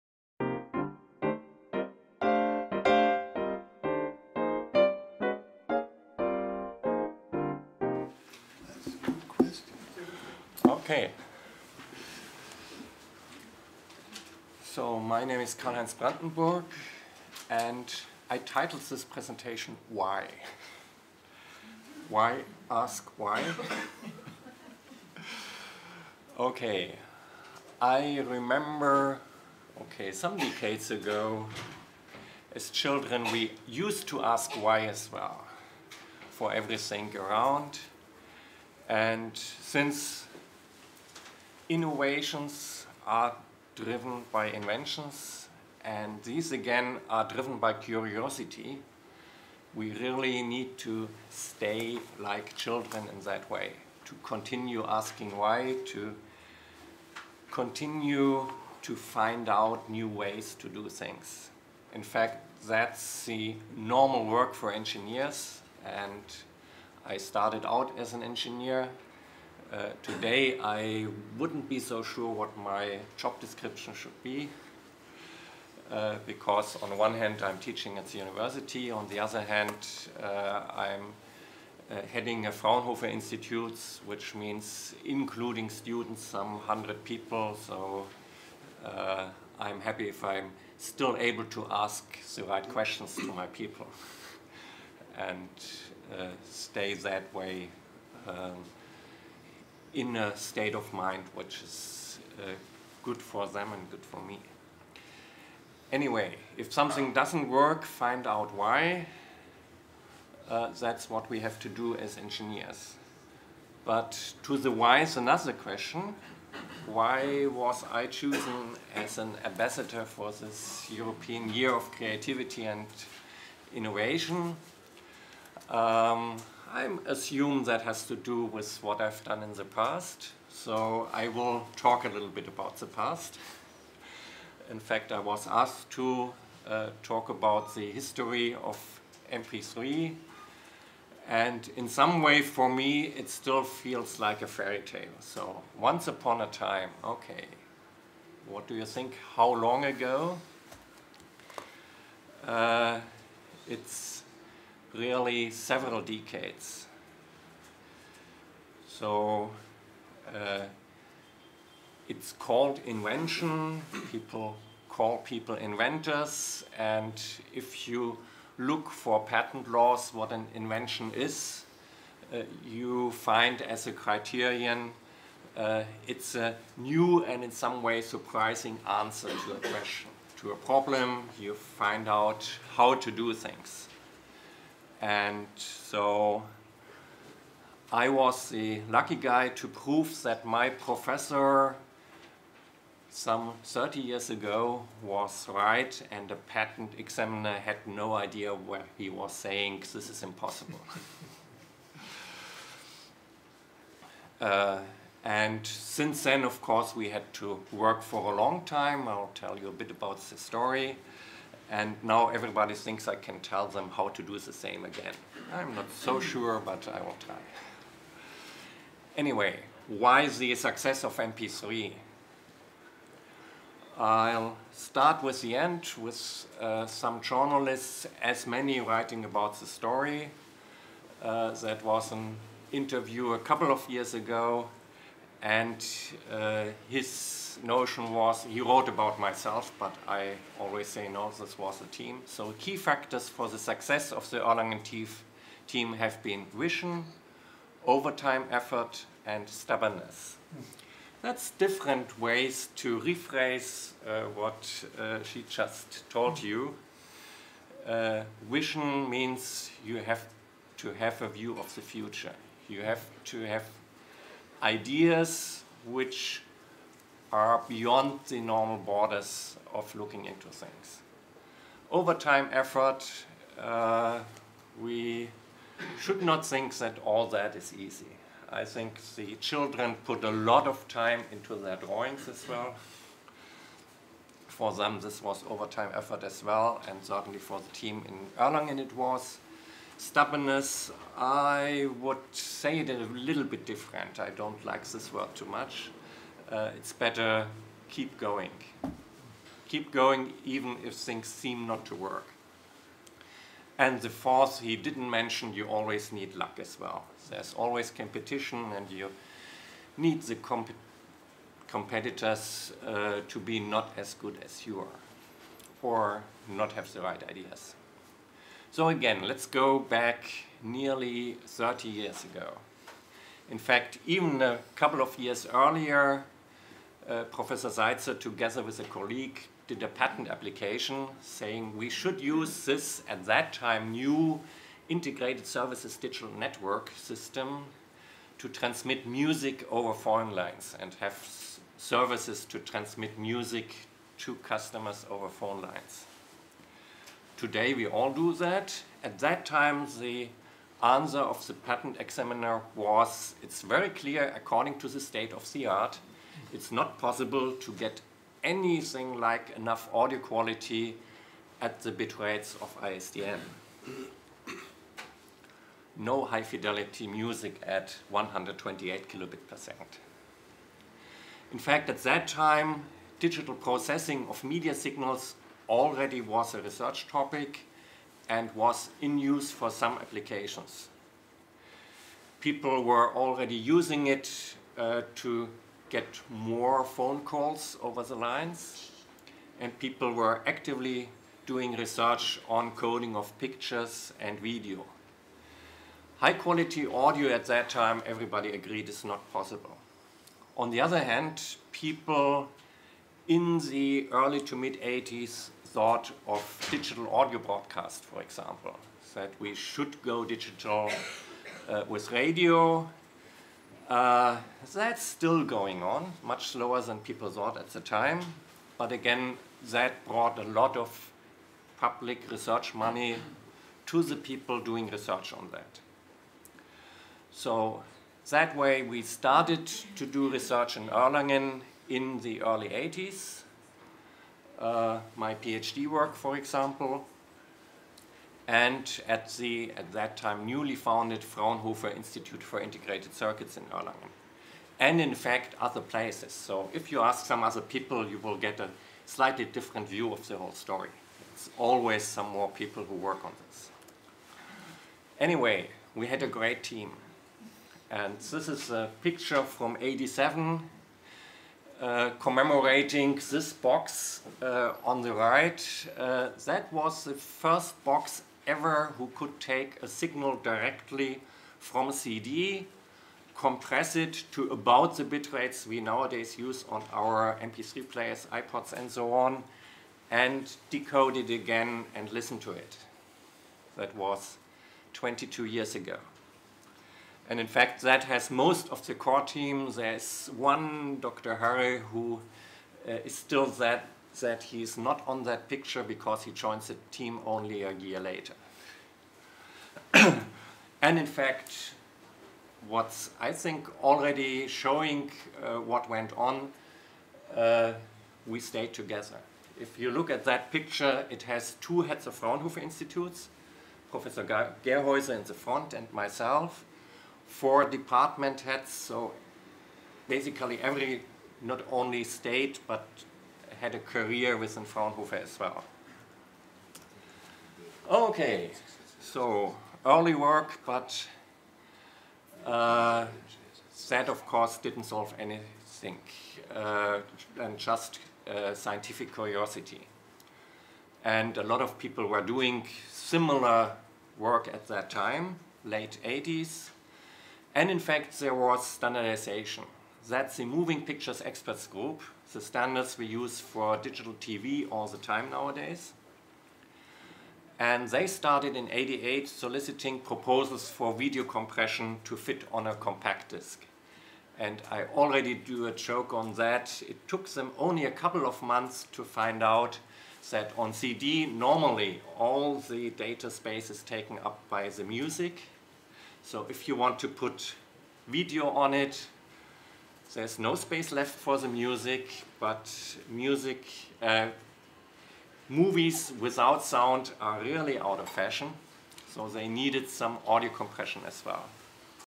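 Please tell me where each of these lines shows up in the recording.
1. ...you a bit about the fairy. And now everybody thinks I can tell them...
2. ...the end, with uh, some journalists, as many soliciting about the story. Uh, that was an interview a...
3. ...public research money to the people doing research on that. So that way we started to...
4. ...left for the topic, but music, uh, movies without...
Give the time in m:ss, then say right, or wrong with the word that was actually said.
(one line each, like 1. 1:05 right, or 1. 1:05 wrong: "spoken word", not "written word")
1. 3:29 wrong: "story", not "fairy"
2. 3:45 wrong: "writing", not "soliciting"
3. 7:01 right
4. 9:40 wrong: "music", not "topic".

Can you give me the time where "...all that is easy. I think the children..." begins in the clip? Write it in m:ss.
4:37.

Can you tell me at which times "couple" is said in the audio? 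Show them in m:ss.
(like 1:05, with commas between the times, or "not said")
3:53, 5:24, 9:27.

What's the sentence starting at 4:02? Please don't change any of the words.
So, key factors for the success of the Erlangen team have been vision, overtime effort, and stubbornness.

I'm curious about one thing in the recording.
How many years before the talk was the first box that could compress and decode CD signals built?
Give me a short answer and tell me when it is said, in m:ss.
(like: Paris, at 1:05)
22, at 8:04.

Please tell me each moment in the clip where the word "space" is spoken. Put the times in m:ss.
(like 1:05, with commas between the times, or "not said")
9:33, 9:40.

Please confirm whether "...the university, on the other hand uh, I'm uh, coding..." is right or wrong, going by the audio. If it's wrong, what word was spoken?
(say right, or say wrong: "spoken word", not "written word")
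wrong: "heading", not "coding".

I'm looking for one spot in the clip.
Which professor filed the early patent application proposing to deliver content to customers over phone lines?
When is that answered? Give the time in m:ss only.
5:27.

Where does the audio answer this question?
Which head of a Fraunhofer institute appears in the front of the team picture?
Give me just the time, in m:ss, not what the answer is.
8:33.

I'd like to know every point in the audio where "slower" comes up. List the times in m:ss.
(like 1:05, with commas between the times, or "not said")
6:56.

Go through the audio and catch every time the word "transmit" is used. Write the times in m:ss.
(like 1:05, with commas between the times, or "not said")
5:38, 5:42.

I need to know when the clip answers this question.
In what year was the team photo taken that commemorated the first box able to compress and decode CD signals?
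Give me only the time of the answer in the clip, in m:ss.
7:39.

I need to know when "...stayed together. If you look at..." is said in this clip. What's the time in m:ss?
8:28.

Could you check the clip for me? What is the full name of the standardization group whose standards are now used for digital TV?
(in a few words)
Moving Pictures Experts Group.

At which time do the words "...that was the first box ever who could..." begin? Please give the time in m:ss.
7:46.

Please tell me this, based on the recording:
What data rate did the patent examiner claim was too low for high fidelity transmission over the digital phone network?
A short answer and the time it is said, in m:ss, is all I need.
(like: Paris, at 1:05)
128 kilobits per second, at 6:08.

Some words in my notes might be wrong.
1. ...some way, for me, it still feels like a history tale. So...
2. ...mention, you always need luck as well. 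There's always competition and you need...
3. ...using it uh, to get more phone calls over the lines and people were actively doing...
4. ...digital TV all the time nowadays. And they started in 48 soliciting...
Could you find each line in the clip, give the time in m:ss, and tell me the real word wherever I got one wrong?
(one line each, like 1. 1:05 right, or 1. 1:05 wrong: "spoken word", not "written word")
1. 2:21 wrong: "fairy", not "history"
2. 5:05 right
3. 6:23 right
4. 9:13 wrong: "88", not "48".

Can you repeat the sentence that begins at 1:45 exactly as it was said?
Anyway, if something doesn't work, find out why.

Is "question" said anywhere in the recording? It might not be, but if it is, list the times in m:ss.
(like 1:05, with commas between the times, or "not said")
1:32, 1:55, 2:59.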